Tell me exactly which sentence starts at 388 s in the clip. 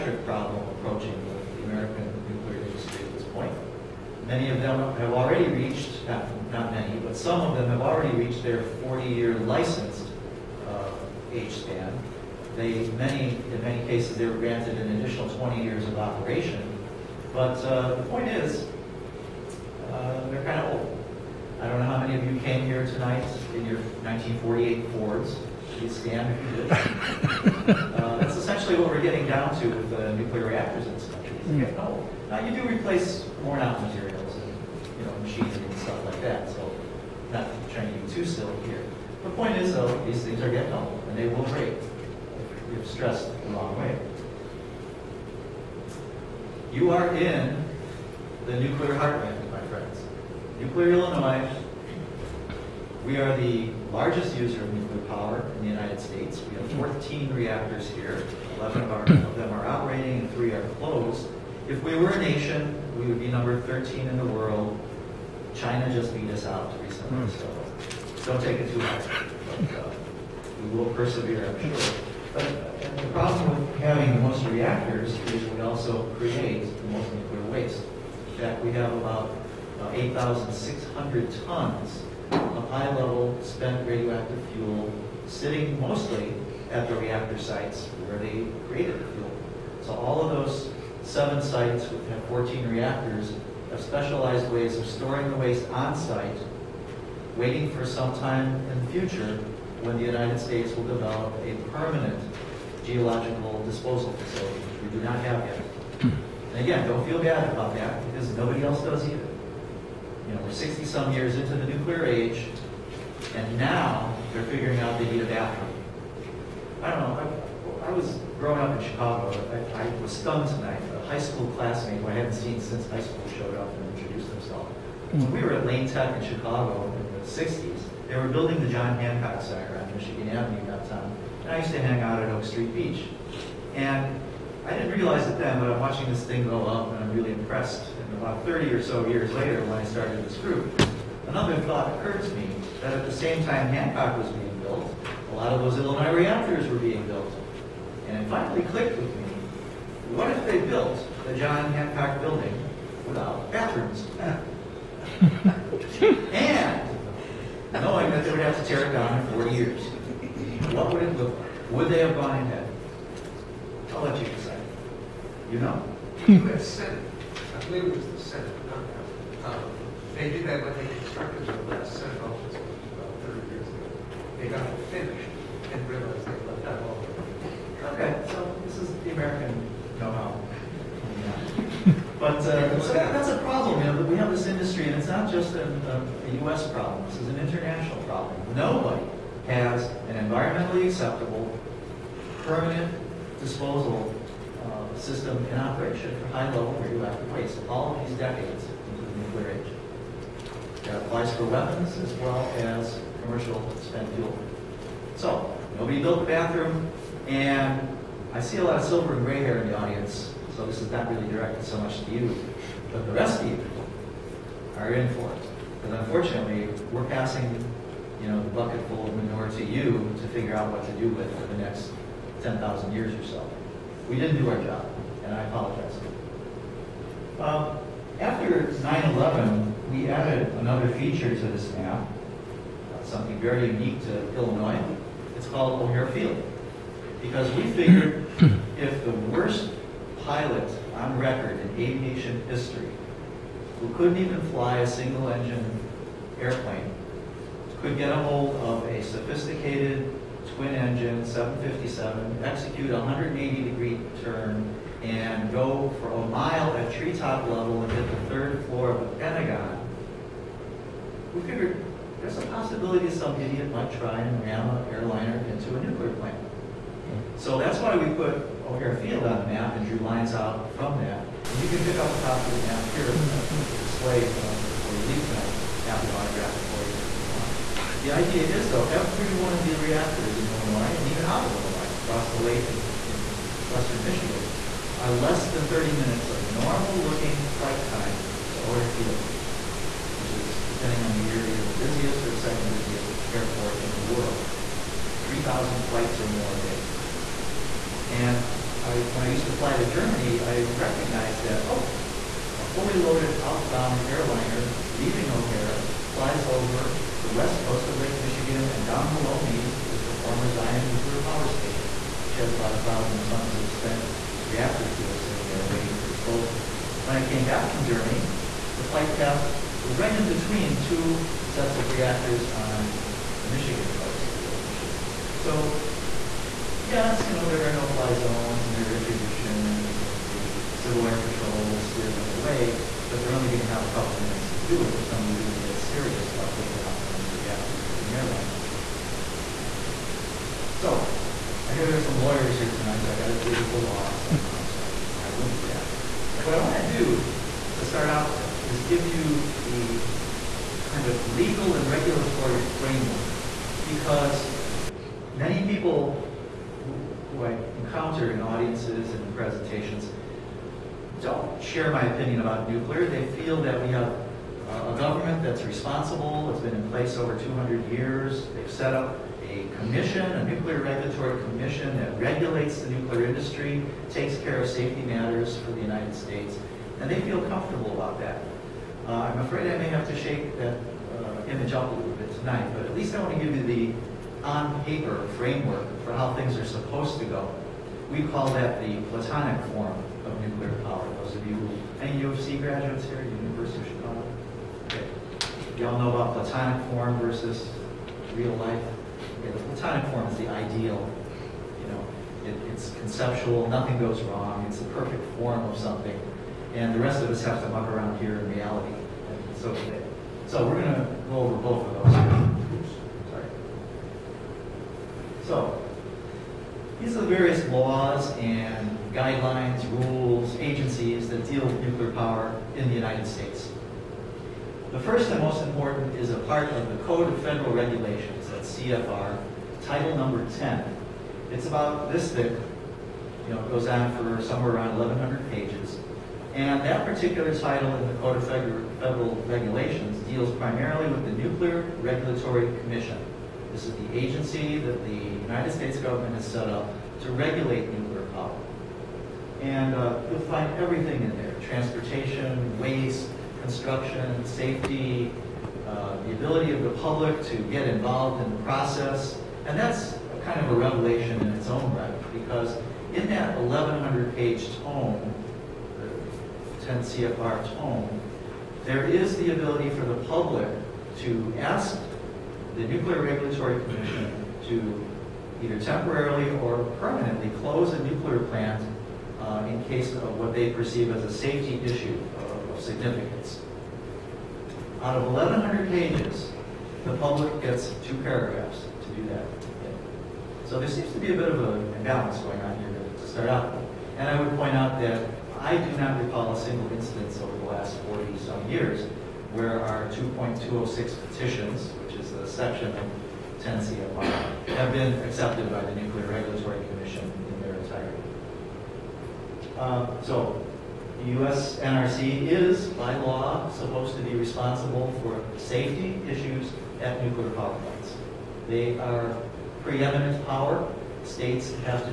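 We call that the platonic form of nuclear power.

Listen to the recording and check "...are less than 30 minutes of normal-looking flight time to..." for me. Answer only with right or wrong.
right.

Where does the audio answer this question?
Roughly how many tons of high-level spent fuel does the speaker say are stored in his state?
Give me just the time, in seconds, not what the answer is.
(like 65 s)
79 s.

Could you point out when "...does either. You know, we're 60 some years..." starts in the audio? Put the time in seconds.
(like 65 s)
108 s.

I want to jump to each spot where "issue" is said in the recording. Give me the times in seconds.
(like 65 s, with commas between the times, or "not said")
481 s, 516 s.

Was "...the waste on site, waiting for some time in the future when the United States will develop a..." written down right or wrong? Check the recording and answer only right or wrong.
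right.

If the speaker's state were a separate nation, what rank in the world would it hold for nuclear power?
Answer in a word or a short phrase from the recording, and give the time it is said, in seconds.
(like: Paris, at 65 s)
13, at 63 s.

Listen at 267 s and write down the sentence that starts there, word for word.
So that's why we put O'Hare Field on the map and drew lines out from that.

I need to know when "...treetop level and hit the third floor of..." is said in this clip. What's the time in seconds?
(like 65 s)
256 s.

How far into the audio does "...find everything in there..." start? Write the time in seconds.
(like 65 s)
450 s.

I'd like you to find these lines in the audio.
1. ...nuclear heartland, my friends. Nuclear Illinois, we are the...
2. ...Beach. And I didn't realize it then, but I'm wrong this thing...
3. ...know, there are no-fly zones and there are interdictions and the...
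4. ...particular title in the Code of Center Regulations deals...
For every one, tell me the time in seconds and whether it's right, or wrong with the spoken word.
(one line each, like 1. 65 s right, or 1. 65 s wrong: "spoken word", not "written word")
1. 48 s right
2. 132 s wrong: "watching", not "wrong"
3. 327 s right
4. 437 s wrong: "Federal", not "Center".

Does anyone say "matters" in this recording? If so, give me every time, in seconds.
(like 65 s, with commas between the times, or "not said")
375 s.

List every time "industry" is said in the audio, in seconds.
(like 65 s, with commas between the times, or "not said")
2 s, 373 s.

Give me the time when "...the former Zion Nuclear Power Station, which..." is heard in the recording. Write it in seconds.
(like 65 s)
310 s.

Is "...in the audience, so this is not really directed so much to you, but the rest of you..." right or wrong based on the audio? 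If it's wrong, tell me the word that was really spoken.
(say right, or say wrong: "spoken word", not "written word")
right.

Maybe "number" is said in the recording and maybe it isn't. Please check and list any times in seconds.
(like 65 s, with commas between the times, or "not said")
63 s, 430 s.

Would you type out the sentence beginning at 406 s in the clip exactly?
And the rest of us have to muck around here in reality.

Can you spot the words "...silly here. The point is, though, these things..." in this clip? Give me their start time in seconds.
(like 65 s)
38 s.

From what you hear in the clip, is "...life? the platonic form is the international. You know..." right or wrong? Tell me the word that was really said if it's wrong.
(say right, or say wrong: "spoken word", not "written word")
wrong: "ideal", not "international".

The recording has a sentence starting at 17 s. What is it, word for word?
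But uh, the point is, uh, they're kind of old.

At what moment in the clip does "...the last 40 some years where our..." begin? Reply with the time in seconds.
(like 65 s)
497 s.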